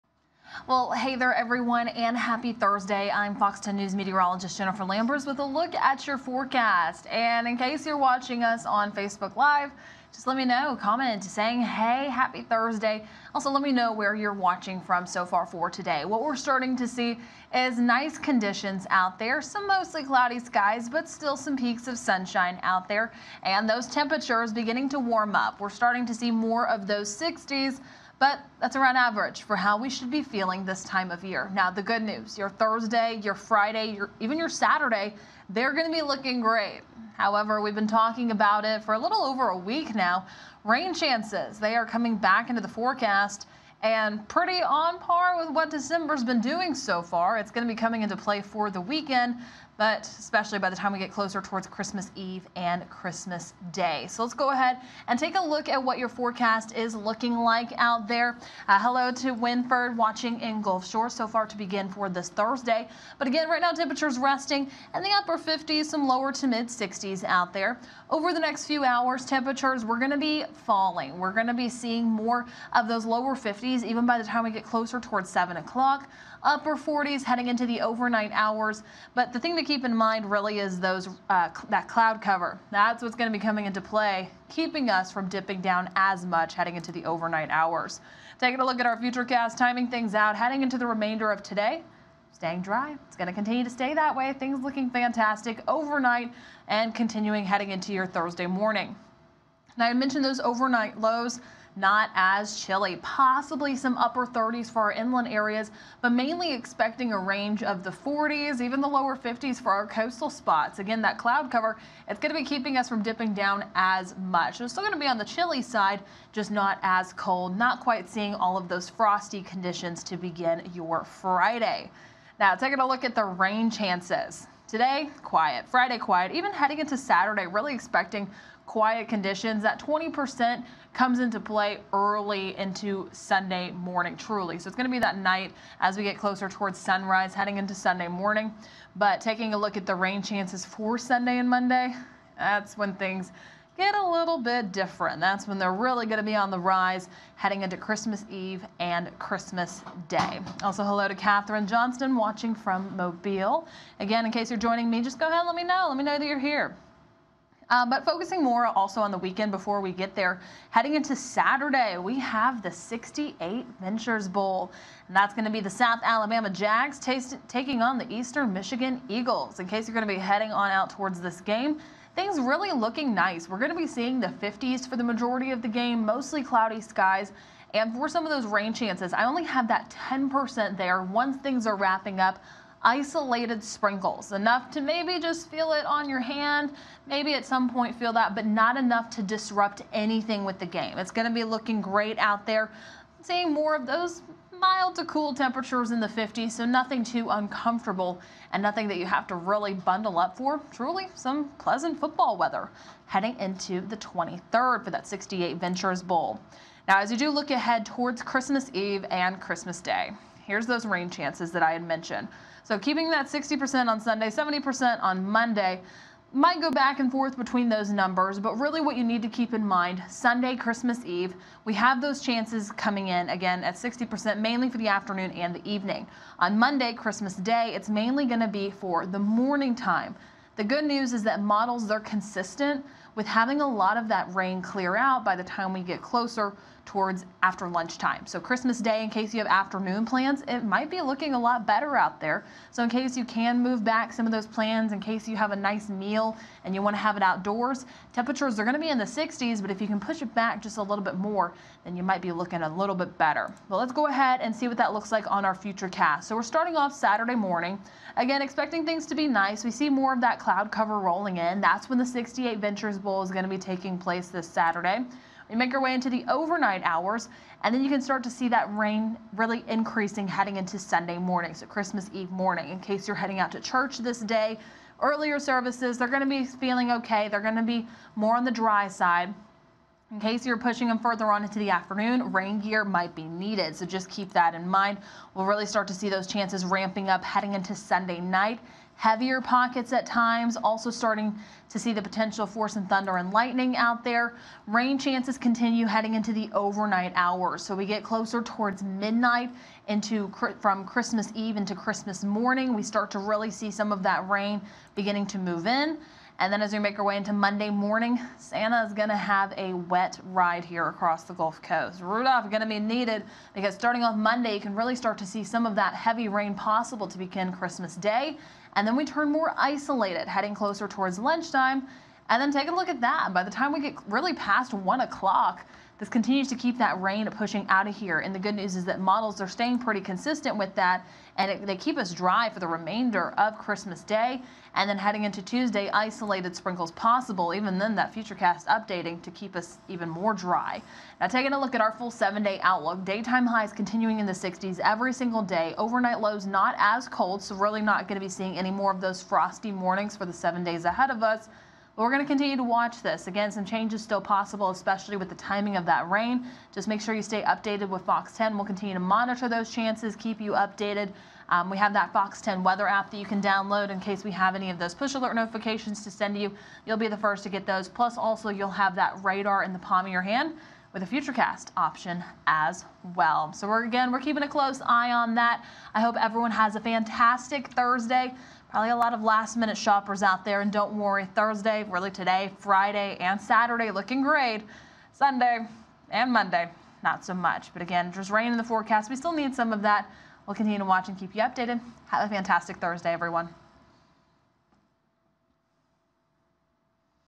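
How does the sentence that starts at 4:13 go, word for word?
But let's go ahead and see what that looks like on our future cast.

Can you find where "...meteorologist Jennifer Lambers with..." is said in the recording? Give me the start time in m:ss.
0:03.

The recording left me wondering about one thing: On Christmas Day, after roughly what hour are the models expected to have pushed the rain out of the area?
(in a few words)
1 o'clock.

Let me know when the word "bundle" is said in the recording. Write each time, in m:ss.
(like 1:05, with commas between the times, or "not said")
3:19.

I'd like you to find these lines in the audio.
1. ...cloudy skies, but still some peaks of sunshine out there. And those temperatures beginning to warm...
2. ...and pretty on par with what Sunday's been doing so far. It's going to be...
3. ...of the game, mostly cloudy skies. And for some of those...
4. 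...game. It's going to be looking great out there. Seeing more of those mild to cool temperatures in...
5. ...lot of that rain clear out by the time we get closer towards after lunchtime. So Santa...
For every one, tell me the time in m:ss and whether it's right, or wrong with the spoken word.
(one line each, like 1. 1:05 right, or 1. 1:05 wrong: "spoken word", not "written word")
1. 0:20 right
2. 0:43 wrong: "December", not "Sunday"
3. 2:55 right
4. 3:10 right
5. 3:53 wrong: "Christmas", not "Santa".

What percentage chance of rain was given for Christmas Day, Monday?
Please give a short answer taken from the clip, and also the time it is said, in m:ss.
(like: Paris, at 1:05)
70%, at 3:34.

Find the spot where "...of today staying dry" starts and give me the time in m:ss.
1:31.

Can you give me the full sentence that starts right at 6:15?
I hope everyone has a fantastic Thursday.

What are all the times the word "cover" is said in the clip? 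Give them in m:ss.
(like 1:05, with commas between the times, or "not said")
1:22, 1:51, 4:20.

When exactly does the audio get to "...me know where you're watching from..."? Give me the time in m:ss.
0:13.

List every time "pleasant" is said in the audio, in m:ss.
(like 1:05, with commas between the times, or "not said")
3:21.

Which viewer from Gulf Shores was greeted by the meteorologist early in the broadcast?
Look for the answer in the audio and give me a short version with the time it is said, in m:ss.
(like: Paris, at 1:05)
Winford, at 0:59.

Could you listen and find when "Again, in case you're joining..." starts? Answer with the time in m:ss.
2:33.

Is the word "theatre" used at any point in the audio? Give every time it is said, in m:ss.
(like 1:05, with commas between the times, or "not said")
not said.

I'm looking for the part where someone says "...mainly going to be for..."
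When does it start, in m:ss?
3:47.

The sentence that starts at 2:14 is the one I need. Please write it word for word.
So it's going to be that night as we get closer towards sunrise, heading into Sunday morning.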